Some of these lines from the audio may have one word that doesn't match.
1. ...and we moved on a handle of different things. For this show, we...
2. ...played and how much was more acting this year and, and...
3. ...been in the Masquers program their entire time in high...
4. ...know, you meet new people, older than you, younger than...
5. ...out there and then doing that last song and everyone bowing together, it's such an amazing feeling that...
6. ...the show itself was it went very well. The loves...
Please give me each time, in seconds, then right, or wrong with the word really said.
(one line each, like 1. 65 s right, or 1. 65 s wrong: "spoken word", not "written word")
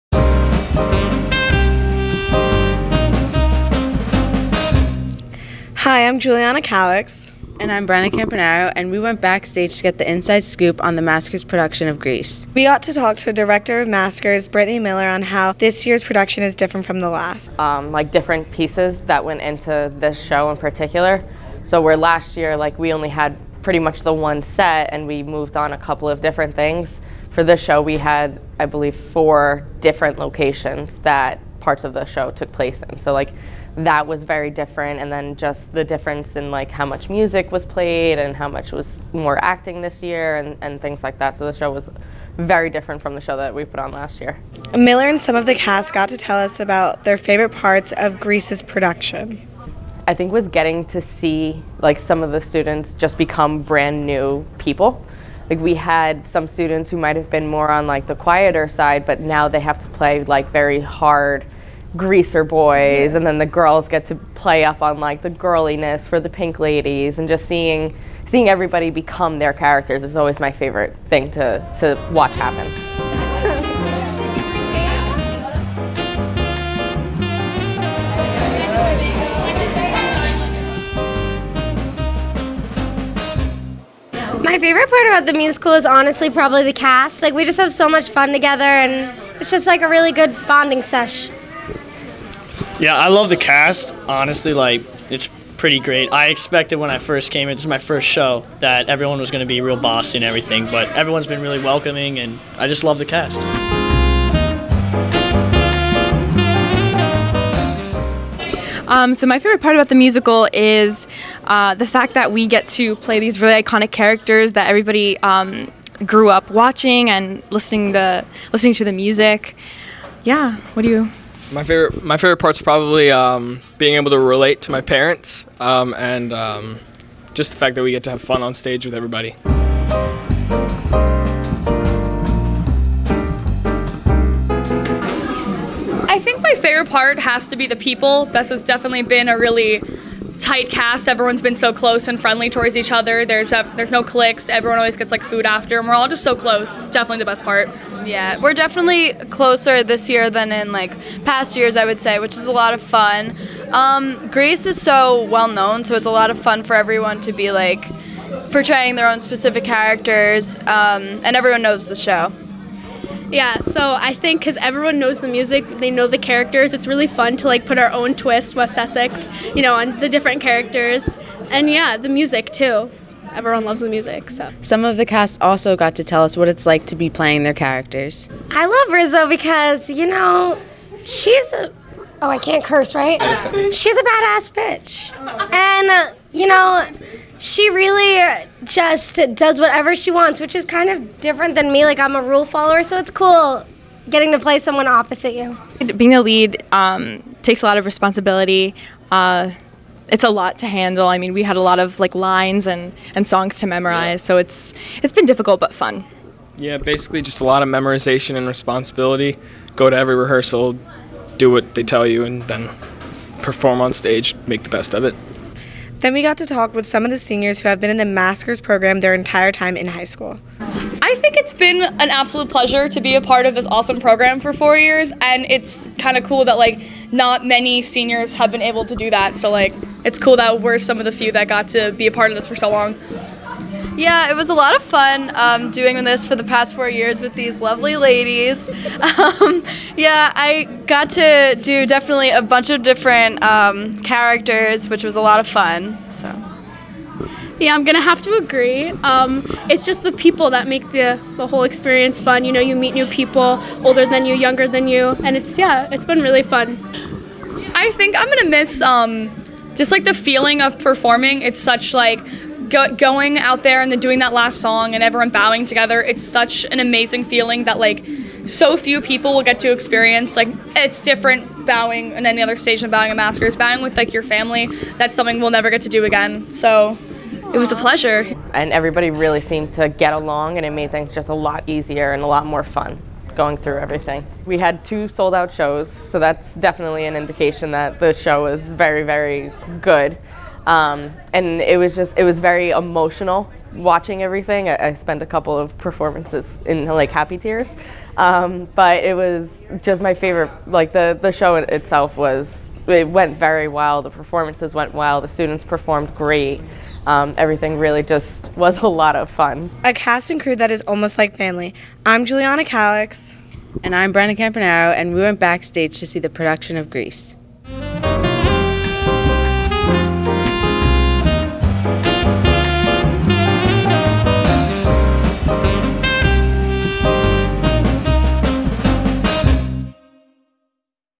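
1. 24 s wrong: "couple", not "handle"
2. 37 s right
3. 217 s right
4. 252 s right
5. 263 s right
6. 301 s wrong: "performances", not "loves".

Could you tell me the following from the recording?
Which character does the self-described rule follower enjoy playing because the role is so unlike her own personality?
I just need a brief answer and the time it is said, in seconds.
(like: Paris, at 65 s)
Rizzo, at 178 s.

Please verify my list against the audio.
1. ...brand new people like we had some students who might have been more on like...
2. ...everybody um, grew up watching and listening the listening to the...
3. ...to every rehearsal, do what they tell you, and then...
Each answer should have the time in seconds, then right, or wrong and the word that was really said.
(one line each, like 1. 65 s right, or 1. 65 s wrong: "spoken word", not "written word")
1. 53 s right
2. 114 s right
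3. 209 s right.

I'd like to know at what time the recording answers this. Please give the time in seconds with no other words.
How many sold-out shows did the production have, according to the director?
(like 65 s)
284 s.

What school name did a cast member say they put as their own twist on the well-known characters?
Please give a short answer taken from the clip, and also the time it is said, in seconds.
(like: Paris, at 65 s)
West Essex, at 168 s.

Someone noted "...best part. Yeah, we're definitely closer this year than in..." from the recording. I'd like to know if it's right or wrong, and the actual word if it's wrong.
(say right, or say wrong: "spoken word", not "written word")
right.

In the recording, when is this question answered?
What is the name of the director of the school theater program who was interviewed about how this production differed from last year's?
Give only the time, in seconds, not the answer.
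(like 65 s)
14 s.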